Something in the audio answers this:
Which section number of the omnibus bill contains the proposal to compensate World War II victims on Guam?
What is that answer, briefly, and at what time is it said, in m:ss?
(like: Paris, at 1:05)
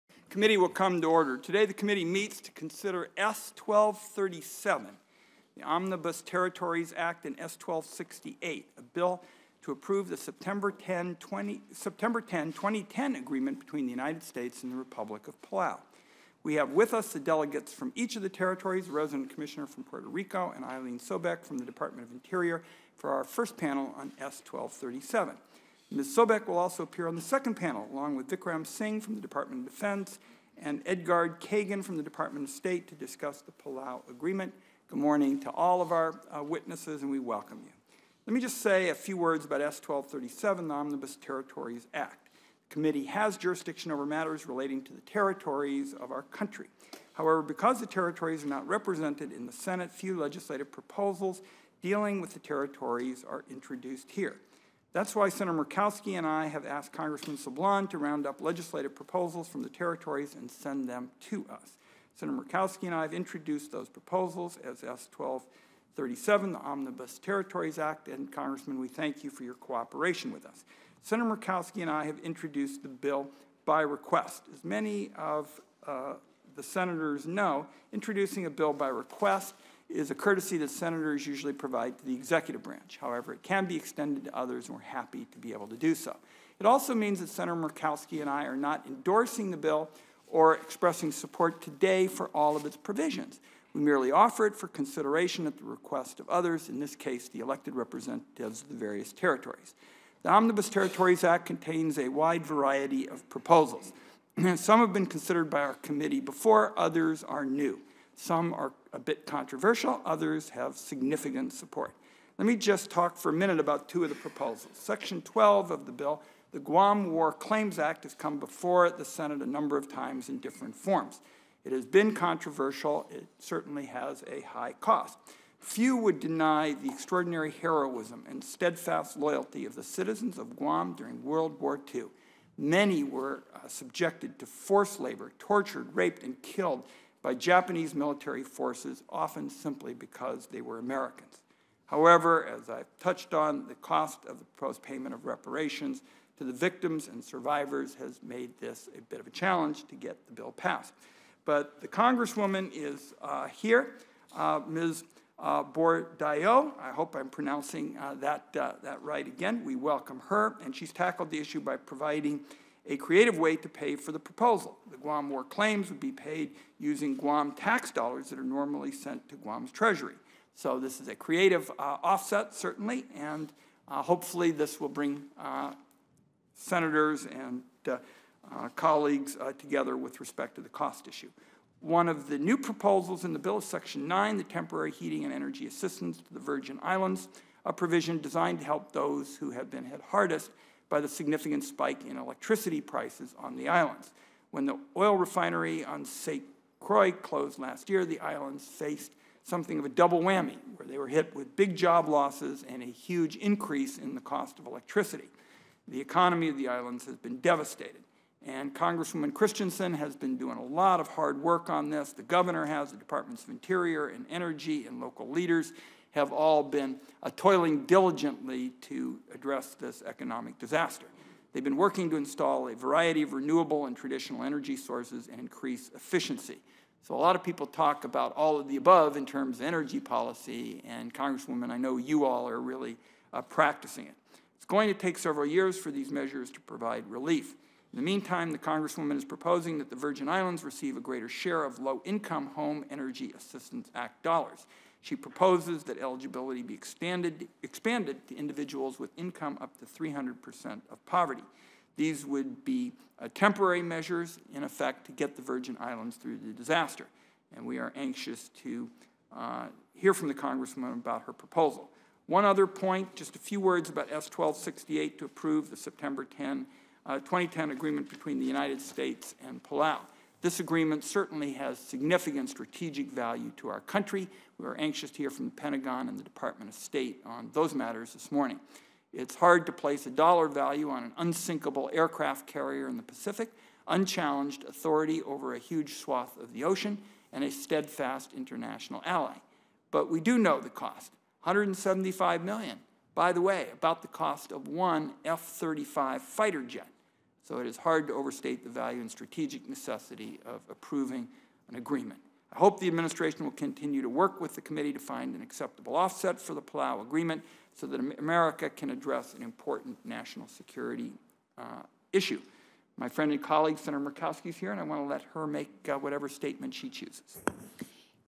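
12, at 1:54.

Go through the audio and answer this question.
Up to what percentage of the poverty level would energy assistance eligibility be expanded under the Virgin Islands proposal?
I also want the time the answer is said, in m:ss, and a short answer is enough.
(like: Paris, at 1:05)
300%, at 4:09.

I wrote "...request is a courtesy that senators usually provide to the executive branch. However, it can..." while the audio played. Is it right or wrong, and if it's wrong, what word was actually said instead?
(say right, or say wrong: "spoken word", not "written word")
right.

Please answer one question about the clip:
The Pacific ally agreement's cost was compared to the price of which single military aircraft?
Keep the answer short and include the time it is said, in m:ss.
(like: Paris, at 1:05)
F-35 fighter jet, at 4:55.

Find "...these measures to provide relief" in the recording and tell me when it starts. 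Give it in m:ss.
3:55.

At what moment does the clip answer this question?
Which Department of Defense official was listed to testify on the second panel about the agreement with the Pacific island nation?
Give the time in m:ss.
0:28.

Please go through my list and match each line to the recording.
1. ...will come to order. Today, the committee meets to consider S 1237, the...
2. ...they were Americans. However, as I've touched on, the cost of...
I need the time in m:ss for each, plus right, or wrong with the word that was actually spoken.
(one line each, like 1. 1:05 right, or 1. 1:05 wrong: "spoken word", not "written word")
1. 0:00 right
2. 2:20 right.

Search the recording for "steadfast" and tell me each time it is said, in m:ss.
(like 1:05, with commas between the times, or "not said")
2:08, 4:47.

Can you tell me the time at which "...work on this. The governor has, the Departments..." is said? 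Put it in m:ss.
3:31.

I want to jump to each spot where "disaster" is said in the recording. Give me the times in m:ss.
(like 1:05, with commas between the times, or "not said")
3:40, 4:16.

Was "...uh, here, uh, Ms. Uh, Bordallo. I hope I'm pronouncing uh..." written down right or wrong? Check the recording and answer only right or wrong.
right.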